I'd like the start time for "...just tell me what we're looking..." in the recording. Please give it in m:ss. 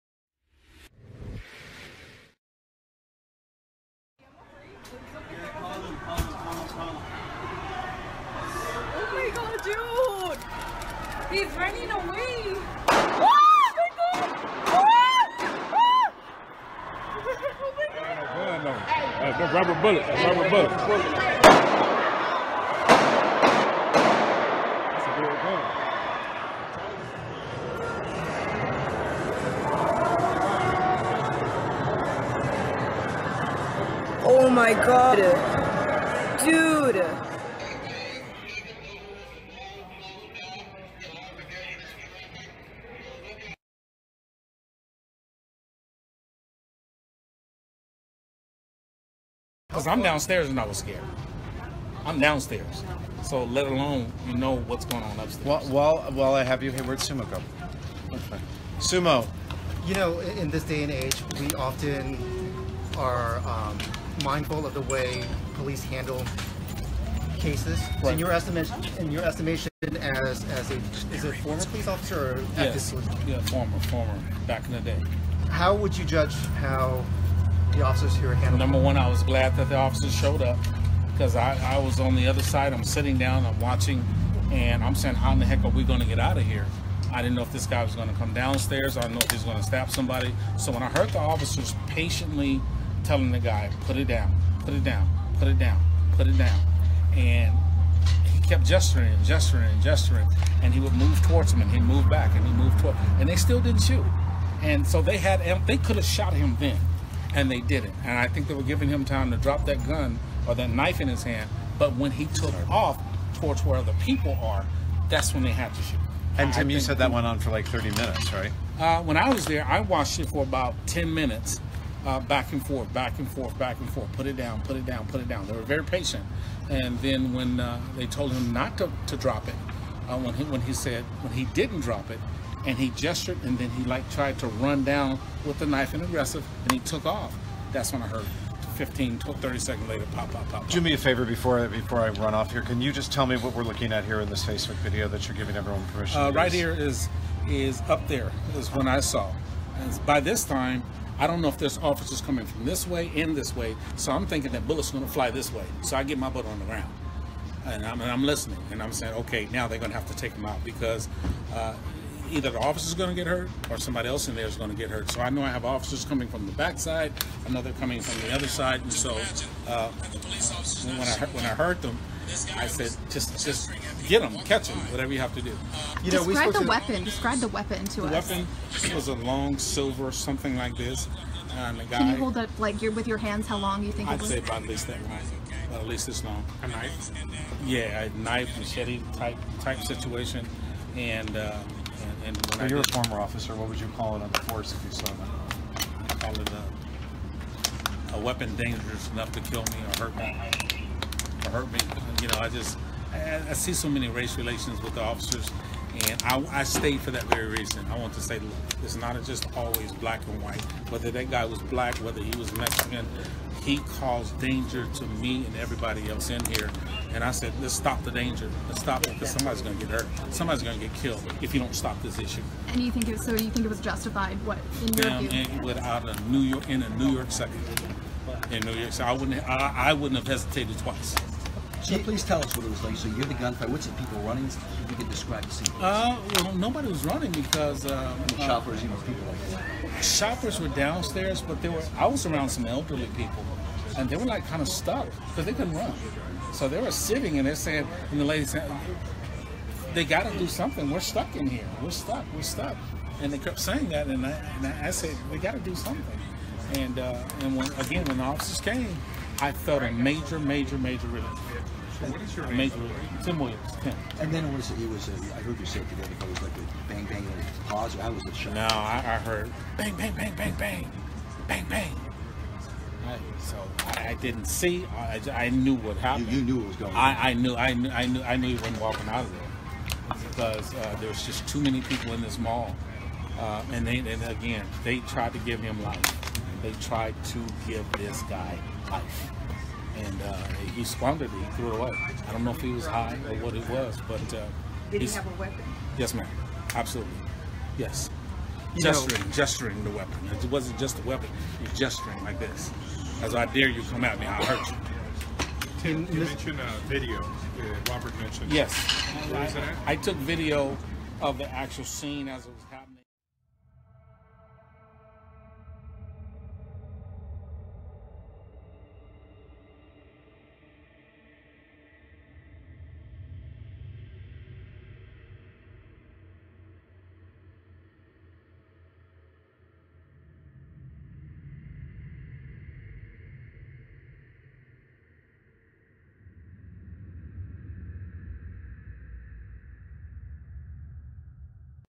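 2:22.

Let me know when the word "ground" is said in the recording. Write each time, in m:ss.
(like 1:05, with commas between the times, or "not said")
2:36.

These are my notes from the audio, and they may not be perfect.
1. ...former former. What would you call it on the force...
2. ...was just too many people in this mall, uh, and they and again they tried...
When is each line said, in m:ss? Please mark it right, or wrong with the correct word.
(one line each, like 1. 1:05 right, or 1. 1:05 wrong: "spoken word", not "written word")
1. 3:12 wrong: "officer", not "former"
2. 4:41 right.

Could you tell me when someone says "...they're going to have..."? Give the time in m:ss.
2:39.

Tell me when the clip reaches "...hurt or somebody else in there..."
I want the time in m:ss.
2:43.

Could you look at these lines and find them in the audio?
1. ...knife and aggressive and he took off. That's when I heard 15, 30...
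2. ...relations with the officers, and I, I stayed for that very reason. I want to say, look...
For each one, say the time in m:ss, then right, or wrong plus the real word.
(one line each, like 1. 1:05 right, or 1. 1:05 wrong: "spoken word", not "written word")
1. 2:15 right
2. 3:24 right.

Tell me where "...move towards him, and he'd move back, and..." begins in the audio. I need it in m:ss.
1:40.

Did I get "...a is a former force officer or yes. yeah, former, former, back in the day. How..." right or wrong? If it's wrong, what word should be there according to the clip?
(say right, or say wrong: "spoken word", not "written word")
wrong: "police", not "force".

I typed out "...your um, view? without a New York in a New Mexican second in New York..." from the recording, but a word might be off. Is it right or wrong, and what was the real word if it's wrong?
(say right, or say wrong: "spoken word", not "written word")
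wrong: "York", not "Mexican".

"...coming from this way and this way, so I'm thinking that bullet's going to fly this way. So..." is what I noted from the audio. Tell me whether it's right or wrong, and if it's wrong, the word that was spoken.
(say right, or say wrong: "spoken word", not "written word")
right.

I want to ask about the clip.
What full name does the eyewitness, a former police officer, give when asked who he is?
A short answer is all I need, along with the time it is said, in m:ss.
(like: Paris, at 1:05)
Tim Williams, at 4:23.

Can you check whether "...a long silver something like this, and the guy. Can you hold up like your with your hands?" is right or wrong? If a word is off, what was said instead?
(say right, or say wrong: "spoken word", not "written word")
right.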